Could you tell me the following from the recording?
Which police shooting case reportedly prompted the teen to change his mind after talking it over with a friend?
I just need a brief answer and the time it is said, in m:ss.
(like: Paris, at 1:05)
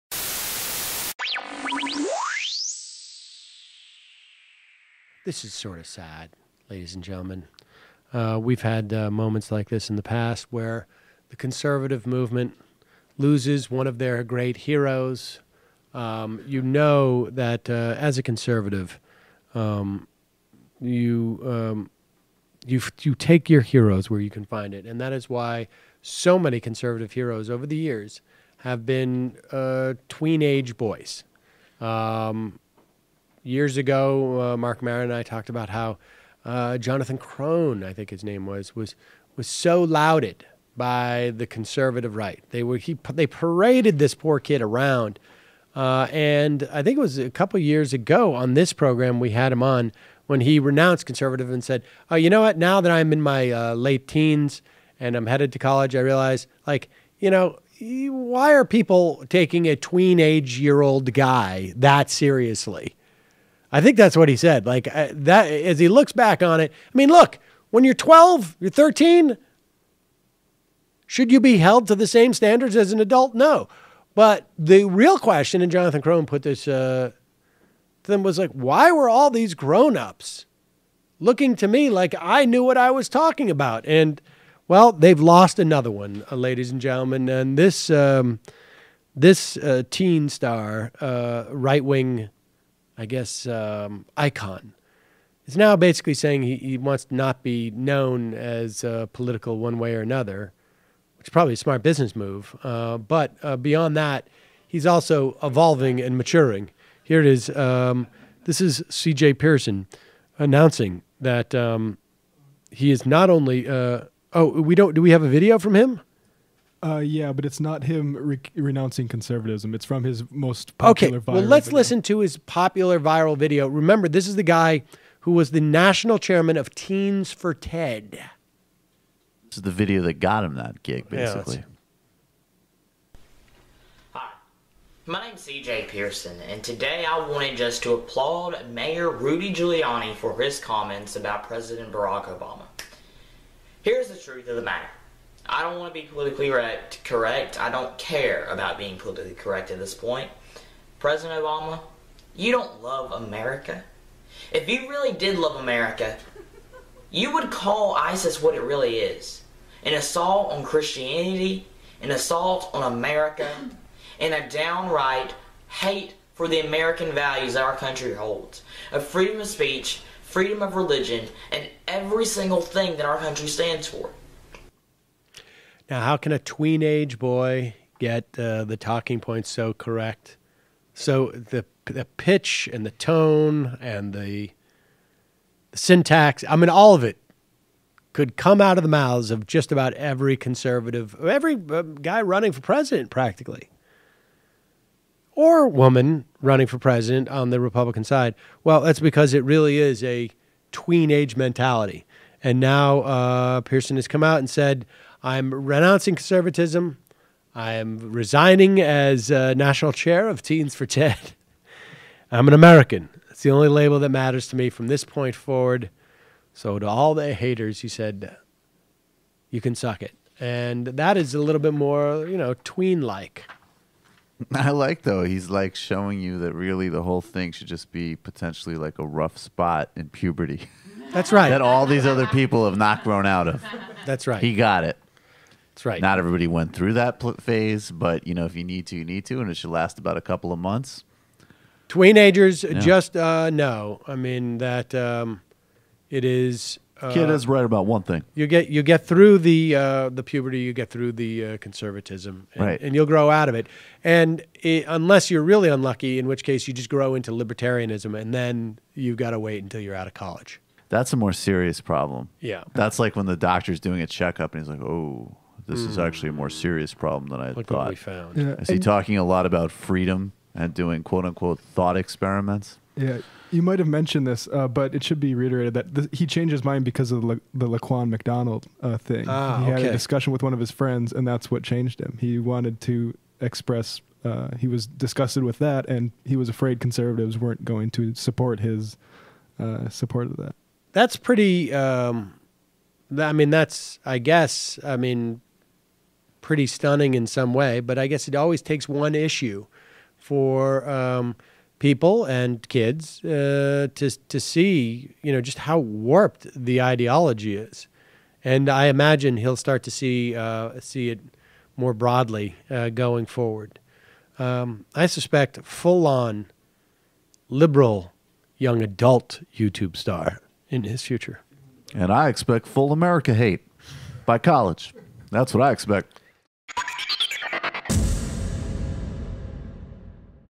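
Laquan McDonald, at 4:37.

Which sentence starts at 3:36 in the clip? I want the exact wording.
So, to all the haters, he said, You can suck it.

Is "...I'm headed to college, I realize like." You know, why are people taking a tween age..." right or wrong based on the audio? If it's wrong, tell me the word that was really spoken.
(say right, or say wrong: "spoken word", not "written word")
right.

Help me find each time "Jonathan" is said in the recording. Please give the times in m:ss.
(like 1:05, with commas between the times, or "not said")
0:36, 1:15.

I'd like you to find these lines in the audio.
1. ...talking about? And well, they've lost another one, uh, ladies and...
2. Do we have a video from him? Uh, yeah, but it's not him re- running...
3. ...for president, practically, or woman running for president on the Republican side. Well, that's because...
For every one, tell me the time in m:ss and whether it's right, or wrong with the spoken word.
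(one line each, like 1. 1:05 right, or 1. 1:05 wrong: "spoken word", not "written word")
1. 1:23 right
2. 1:54 wrong: "renouncing", not "running"
3. 3:12 right.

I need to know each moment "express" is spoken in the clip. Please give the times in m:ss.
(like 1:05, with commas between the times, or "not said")
4:43.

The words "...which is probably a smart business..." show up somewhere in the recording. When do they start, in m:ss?
1:41.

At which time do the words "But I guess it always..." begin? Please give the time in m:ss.
4:57.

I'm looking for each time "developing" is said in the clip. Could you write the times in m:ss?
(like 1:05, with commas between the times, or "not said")
not said.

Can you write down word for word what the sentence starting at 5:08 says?
And I imagine he'll start to see uh, see it more broadly uh, going forward.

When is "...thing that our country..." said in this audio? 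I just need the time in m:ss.
2:52.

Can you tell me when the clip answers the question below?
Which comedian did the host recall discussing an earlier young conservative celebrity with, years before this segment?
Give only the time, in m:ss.
0:34.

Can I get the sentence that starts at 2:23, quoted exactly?
Here's the truth of the matter.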